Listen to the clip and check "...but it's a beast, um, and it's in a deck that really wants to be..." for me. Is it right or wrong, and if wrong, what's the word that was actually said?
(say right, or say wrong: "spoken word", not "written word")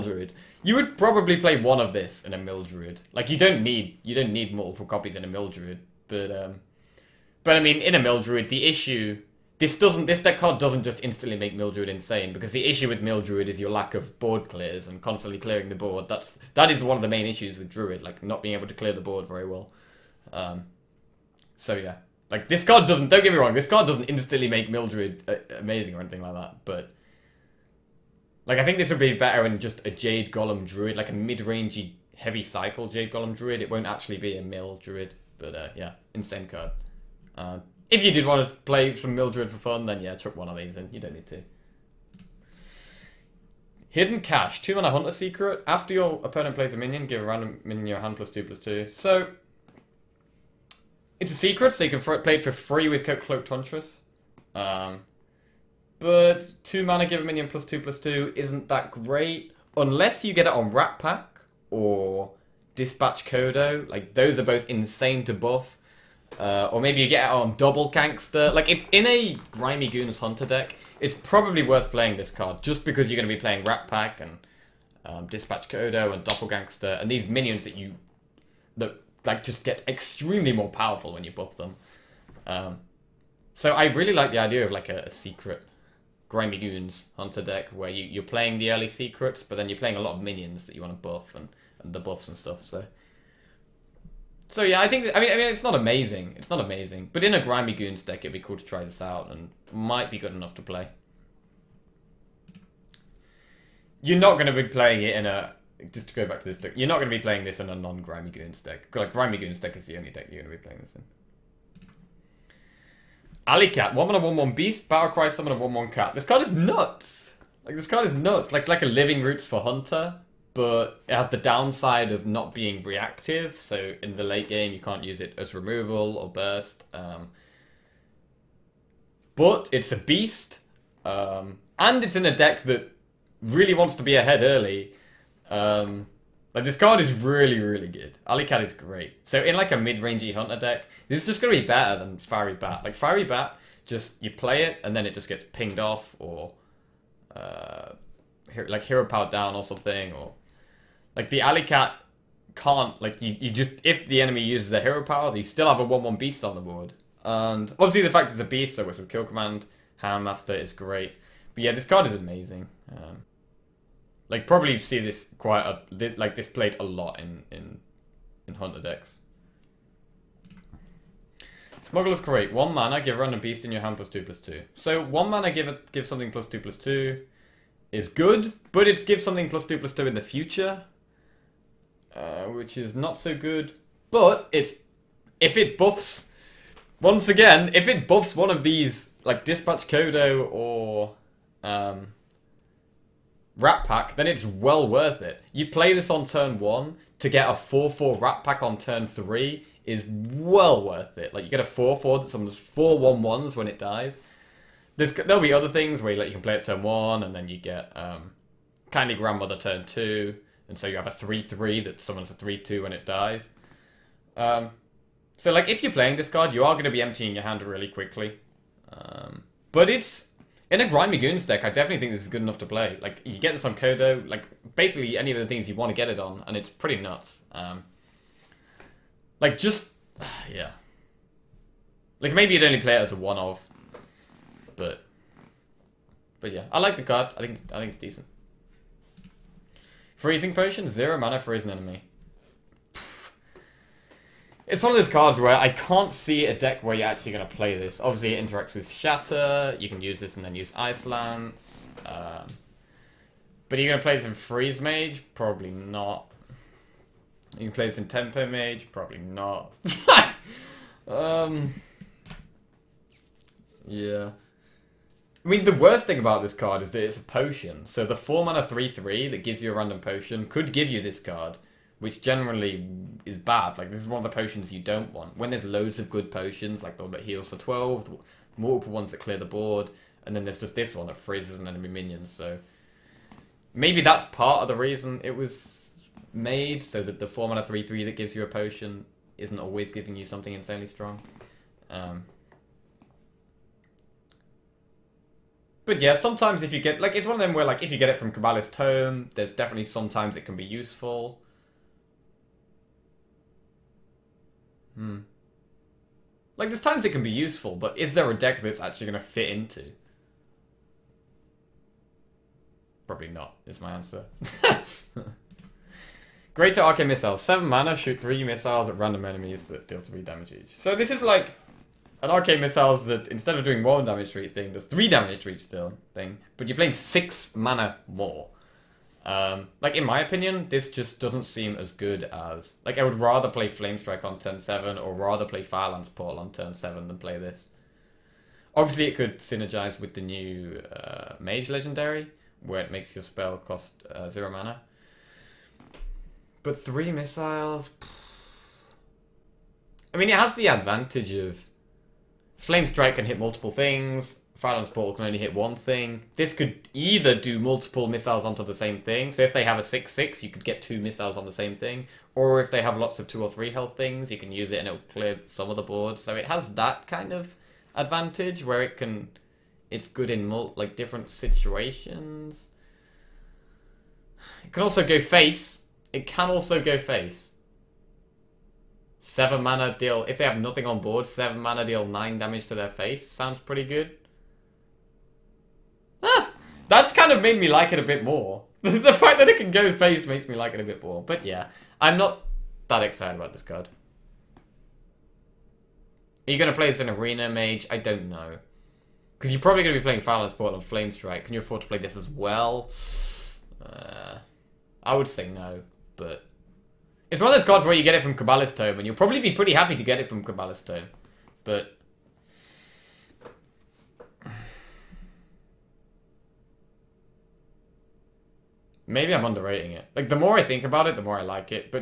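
right.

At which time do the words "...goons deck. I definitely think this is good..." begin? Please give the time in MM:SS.
03:41.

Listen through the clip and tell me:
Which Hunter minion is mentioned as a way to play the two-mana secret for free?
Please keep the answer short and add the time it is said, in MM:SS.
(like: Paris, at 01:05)
Cloak Huntress, at 00:53.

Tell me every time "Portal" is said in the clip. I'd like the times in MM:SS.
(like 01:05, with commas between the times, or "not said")
05:36, 05:54, 06:40.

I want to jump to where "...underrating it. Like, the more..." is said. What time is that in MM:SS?
06:59.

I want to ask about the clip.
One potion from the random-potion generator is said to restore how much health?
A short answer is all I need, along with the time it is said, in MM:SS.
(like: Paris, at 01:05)
12, at 04:37.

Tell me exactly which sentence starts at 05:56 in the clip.
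This could either do multiple missiles onto the same thing.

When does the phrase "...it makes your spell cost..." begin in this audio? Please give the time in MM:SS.
05:42.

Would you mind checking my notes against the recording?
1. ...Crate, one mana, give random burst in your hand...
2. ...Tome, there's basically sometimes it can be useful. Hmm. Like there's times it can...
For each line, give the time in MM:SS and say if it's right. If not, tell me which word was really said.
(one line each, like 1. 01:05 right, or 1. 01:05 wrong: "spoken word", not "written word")
1. 02:52 wrong: "beast", not "burst"
2. 04:58 wrong: "definitely", not "basically".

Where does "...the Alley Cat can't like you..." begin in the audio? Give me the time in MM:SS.
02:31.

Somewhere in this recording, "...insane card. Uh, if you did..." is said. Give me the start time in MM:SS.
00:36.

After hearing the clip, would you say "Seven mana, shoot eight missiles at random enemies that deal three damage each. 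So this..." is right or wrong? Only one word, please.
wrong.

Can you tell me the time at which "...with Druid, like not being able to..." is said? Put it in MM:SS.
00:17.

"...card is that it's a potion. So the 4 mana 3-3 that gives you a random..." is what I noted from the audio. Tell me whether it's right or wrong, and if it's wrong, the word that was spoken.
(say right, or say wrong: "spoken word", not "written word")
right.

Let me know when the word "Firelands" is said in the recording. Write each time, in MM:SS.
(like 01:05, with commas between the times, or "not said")
05:35, 05:54, 06:40.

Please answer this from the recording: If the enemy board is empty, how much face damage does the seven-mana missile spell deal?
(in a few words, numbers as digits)
9.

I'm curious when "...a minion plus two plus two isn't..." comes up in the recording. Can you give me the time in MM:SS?
00:57.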